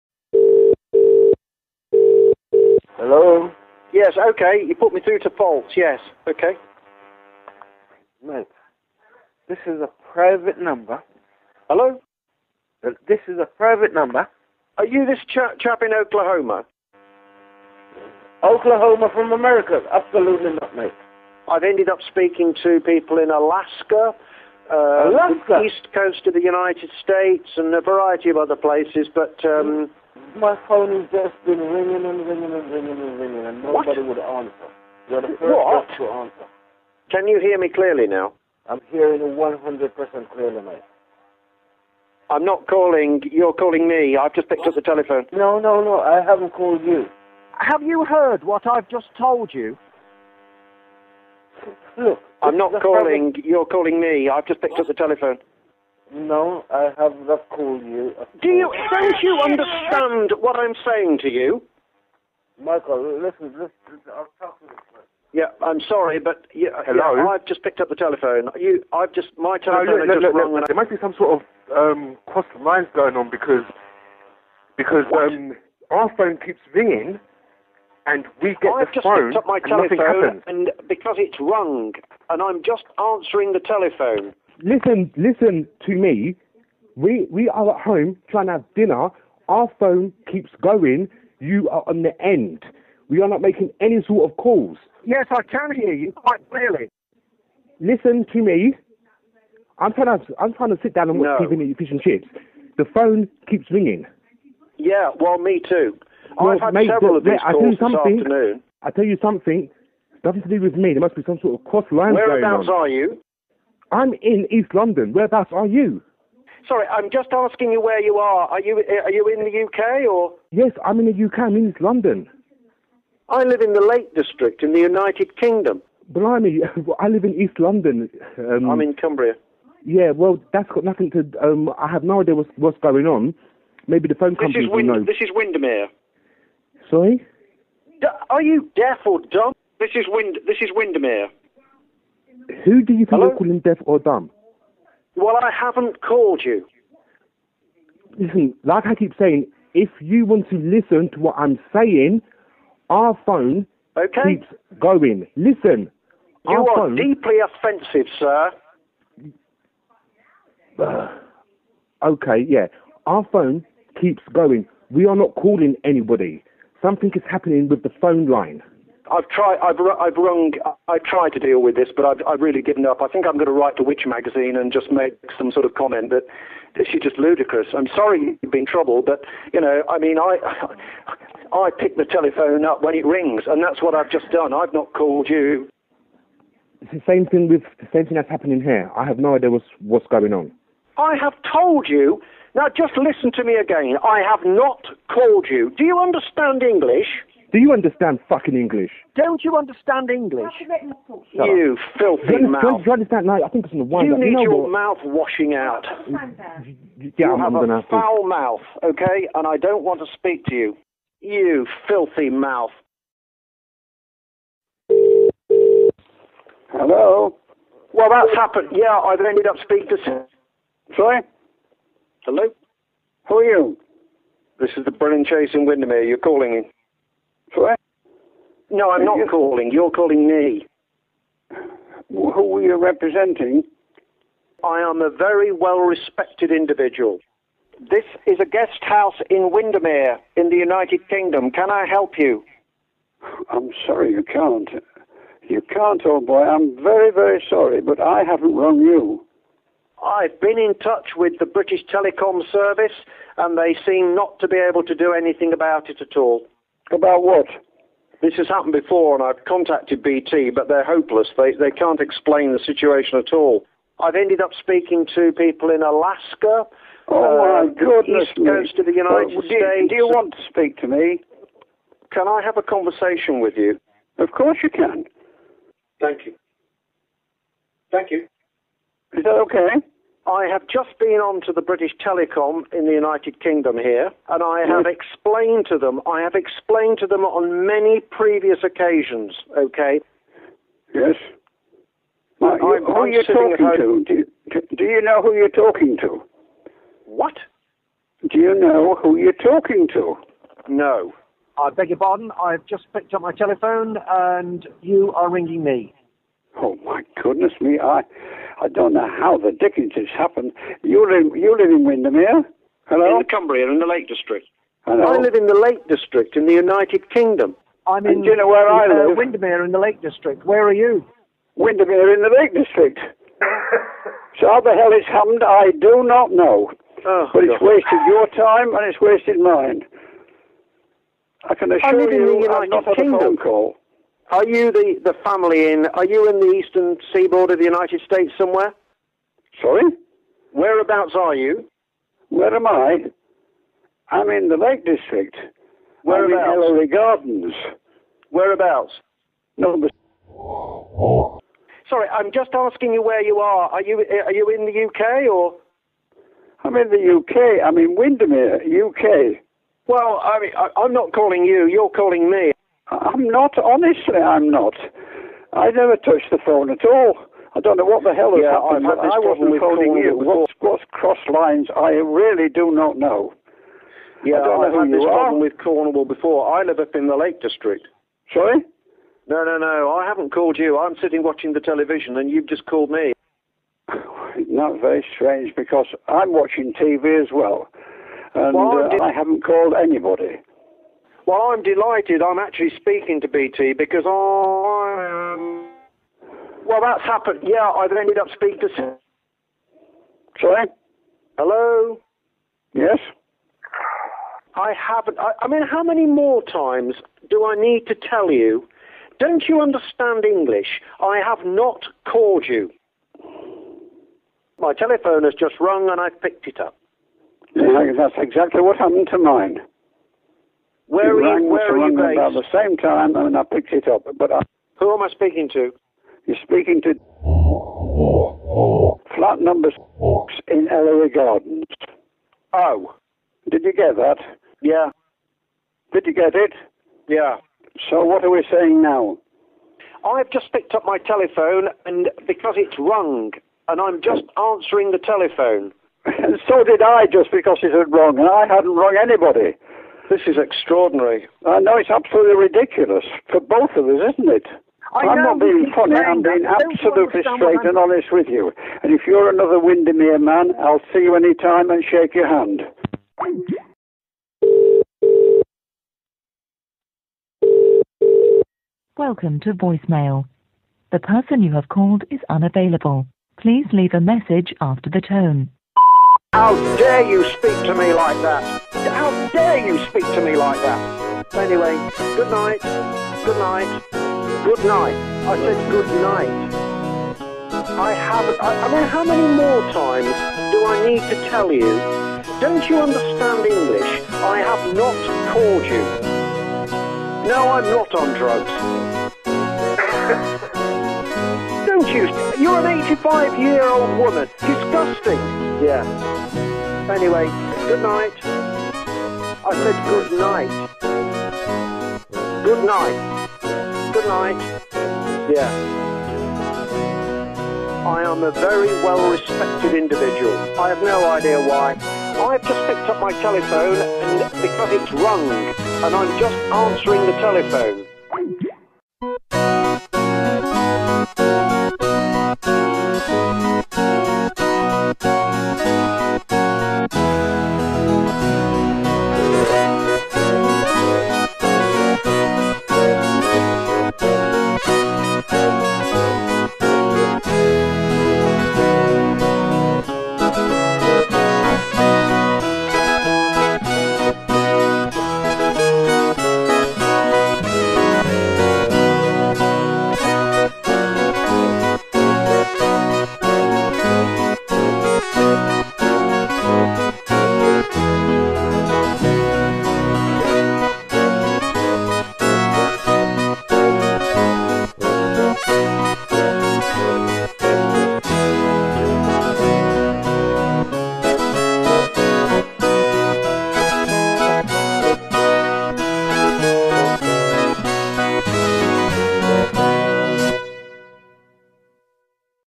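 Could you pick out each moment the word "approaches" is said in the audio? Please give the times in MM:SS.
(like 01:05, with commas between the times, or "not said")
not said.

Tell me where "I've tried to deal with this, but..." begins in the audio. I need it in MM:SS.
02:50.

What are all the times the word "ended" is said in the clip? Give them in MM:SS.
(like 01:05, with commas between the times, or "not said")
00:21, 03:39, 04:24, 06:37.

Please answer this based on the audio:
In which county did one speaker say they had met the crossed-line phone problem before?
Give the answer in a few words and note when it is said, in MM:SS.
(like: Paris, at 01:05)
Cornwall, at 06:15.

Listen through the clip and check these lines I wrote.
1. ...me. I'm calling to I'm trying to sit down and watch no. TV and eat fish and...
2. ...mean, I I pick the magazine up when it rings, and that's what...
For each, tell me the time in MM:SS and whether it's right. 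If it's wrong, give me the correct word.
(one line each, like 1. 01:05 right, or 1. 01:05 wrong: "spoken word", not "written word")
1. 01:38 wrong: "trying", not "calling"
2. 02:59 wrong: "telephone", not "magazine".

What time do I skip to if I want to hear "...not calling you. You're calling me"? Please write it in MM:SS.
06:00.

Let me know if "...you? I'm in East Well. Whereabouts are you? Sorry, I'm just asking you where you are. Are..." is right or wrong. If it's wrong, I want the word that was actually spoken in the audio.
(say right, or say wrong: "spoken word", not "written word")
wrong: "London", not "Well".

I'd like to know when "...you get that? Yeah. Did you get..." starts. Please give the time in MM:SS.
07:13.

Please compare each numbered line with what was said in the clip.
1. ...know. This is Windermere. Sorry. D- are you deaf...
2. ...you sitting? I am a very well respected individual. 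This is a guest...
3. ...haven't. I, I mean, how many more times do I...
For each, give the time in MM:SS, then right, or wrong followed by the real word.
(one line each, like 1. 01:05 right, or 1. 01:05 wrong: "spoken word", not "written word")
1. 02:14 right
2. 03:52 wrong: "representing", not "sitting"
3. 06:44 right.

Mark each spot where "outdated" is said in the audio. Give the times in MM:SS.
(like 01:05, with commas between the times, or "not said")
not said.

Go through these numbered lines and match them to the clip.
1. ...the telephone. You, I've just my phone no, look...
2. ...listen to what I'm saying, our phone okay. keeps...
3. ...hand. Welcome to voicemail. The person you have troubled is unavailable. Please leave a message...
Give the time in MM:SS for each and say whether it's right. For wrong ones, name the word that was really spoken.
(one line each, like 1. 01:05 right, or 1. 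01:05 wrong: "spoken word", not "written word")
1. 01:07 wrong: "telephone", not "phone"
2. 02:30 right
3. 07:42 wrong: "called", not "troubled".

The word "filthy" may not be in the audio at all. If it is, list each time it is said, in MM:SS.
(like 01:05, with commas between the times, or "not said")
03:21, 03:31.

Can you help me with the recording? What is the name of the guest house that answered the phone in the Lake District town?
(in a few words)
Brennan Chase.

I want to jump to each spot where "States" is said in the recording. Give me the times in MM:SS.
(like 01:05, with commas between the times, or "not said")
00:27, 04:29, 05:38.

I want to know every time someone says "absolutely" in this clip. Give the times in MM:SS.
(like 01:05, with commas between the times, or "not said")
00:19, 07:31, 07:36.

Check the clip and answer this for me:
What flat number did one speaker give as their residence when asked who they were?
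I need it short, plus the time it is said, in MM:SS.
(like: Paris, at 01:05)
6, at 07:09.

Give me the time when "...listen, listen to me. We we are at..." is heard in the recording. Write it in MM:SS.
01:24.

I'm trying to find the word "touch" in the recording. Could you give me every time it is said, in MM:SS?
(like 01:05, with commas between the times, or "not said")
04:10, 06:05.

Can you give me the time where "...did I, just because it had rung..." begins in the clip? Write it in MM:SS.
07:26.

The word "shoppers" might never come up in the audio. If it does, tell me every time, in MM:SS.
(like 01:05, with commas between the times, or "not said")
not said.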